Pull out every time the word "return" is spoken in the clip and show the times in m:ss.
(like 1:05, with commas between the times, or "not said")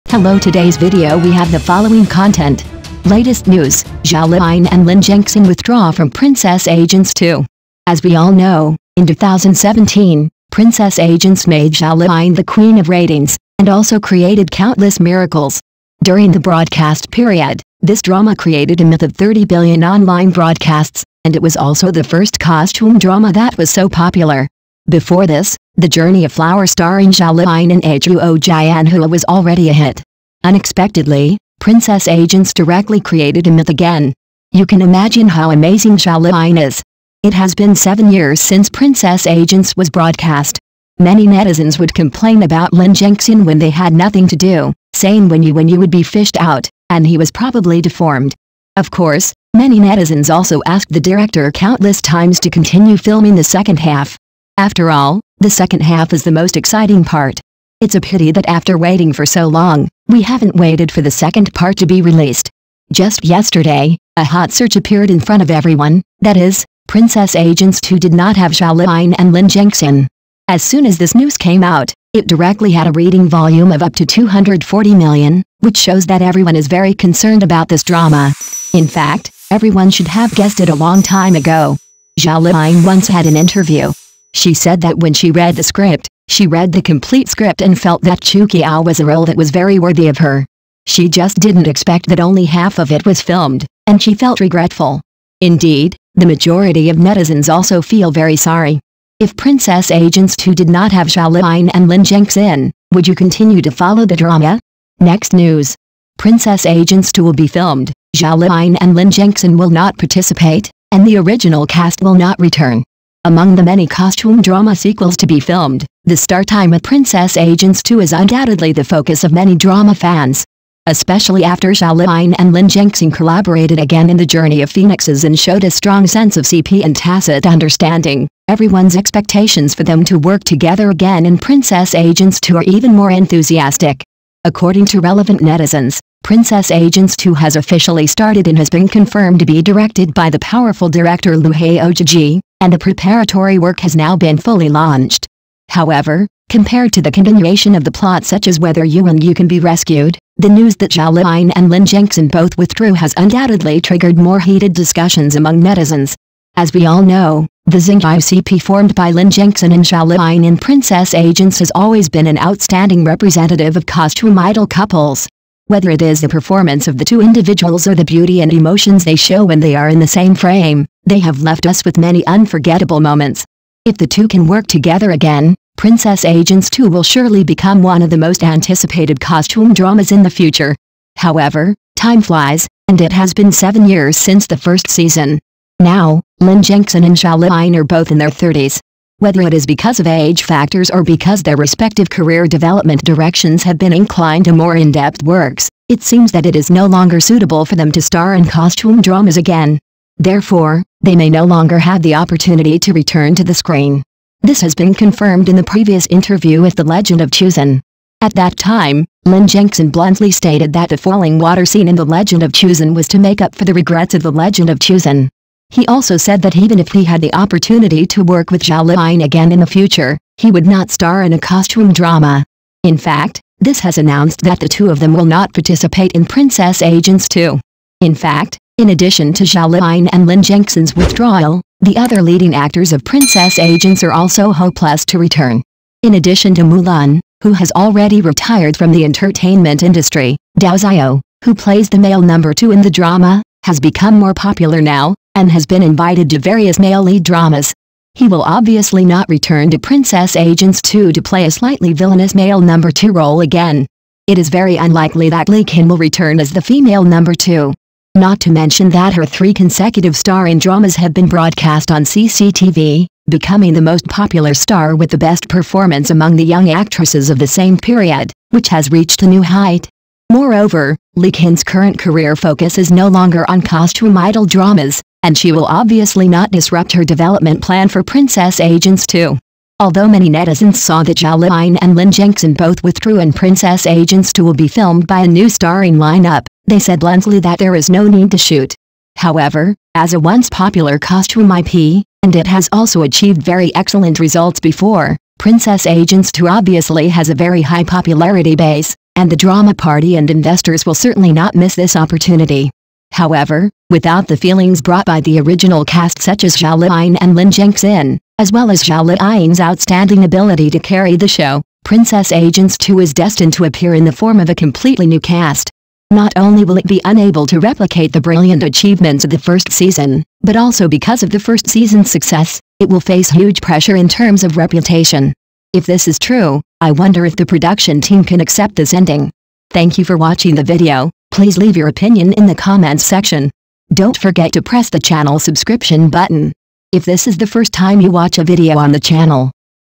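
1:52, 3:22, 3:55, 4:09, 4:15.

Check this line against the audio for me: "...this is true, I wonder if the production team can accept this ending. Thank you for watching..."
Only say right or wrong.
right.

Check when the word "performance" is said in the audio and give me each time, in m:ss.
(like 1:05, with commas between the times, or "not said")
2:46, 4:25.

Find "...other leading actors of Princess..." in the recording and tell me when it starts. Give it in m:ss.
3:51.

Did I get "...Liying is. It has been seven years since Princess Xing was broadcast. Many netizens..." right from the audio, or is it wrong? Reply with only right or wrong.
wrong.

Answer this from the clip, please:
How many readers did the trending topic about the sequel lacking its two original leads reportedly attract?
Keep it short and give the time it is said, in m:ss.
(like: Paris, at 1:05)
240 million, at 1:14.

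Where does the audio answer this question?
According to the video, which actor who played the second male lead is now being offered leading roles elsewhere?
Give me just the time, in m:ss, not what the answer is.
4:00.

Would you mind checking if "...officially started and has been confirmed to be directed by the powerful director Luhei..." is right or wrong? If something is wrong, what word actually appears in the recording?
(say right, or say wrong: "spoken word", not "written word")
right.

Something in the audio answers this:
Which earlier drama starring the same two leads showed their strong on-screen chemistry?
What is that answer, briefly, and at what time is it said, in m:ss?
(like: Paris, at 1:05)
The Journey of Phoenixes, at 2:04.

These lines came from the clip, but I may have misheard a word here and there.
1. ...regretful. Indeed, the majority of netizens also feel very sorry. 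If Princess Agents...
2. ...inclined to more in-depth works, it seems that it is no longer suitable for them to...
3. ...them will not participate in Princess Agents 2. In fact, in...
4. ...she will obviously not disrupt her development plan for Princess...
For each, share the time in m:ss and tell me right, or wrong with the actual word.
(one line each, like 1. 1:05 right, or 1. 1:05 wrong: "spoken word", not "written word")
1. 1:34 right
2. 3:13 right
3. 3:44 right
4. 4:35 right.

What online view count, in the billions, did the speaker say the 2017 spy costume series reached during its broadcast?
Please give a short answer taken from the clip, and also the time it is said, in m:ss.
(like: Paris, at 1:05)
30 billion, at 0:19.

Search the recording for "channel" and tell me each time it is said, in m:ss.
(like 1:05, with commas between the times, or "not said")
5:34, 5:38.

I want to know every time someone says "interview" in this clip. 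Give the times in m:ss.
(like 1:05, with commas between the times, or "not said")
1:23, 3:26.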